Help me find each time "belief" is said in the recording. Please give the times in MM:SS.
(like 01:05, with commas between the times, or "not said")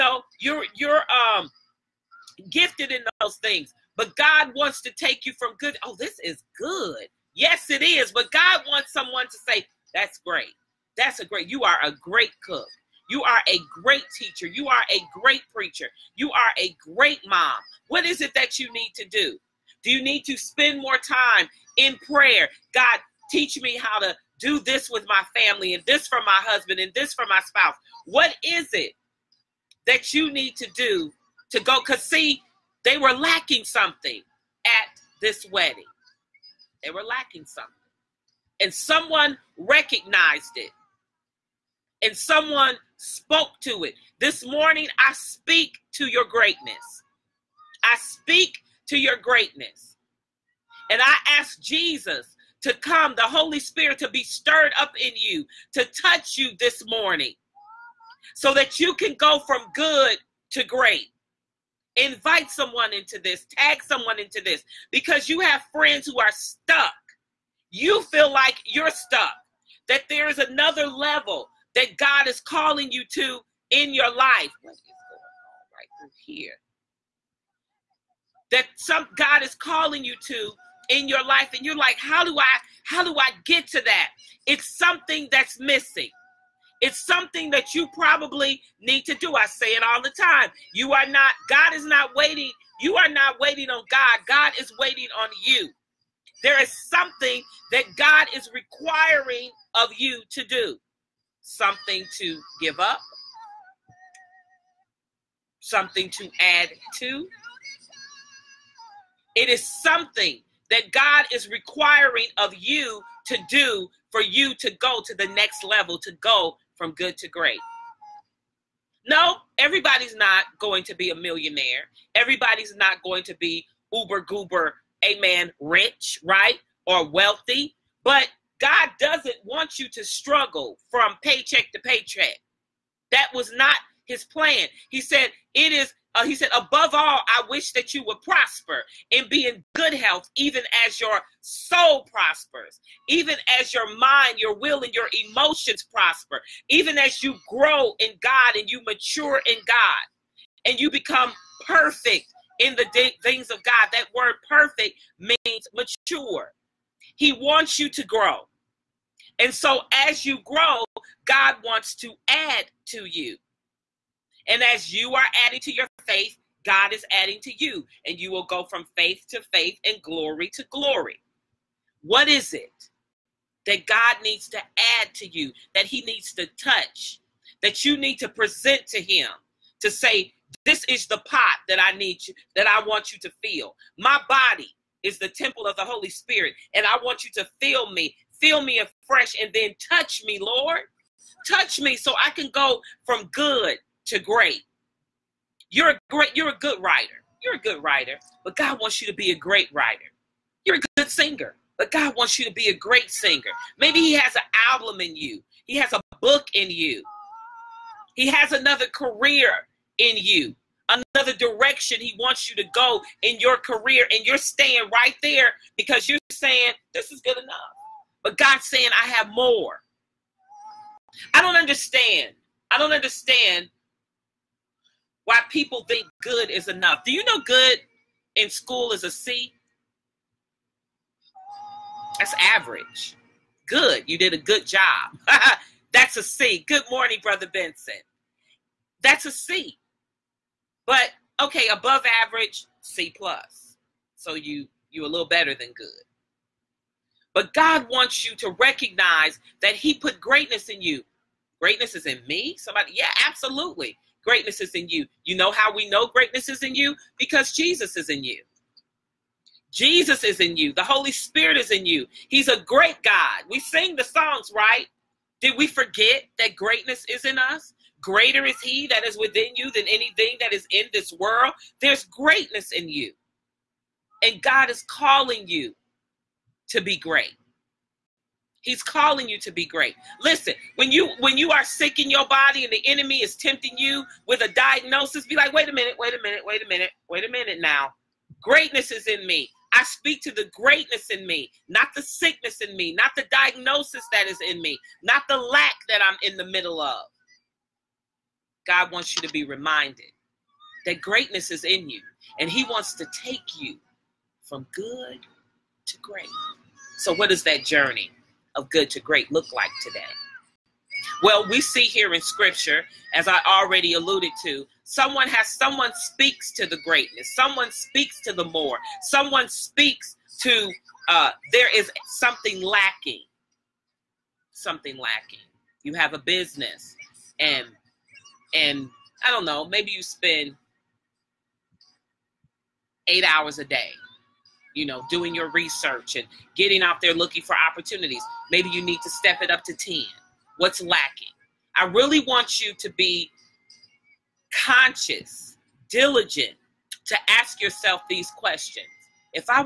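not said.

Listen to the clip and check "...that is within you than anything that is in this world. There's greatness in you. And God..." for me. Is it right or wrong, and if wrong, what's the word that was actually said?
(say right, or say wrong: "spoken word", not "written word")
right.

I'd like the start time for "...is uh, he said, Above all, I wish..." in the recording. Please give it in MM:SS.
02:15.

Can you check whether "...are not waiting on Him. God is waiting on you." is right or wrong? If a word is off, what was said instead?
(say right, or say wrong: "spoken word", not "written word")
wrong: "God", not "Him".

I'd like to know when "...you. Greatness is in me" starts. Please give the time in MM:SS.
04:10.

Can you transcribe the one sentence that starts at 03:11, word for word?
Touch me so I can go from good to great.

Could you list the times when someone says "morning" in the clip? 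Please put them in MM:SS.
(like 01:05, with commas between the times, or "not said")
00:44, 00:56, 03:56.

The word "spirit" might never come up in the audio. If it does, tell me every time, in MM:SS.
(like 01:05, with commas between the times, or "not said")
00:53, 03:06, 04:21.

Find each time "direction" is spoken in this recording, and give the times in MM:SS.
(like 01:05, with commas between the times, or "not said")
03:31.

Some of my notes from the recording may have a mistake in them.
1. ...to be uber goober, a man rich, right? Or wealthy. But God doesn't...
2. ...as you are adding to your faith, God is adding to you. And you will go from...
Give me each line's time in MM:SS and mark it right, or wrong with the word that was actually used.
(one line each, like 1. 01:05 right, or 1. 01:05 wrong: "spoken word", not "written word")
1. 02:03 right
2. 02:44 right.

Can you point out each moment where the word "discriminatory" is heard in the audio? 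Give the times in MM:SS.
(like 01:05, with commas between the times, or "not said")
not said.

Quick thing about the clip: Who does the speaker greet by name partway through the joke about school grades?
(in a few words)
Brother Benson.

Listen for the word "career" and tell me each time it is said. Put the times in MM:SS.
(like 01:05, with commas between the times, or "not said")
03:28, 03:33.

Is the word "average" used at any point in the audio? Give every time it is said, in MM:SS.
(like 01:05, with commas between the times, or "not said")
03:52, 04:02.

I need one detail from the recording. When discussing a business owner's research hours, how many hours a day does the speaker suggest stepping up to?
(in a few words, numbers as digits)
10.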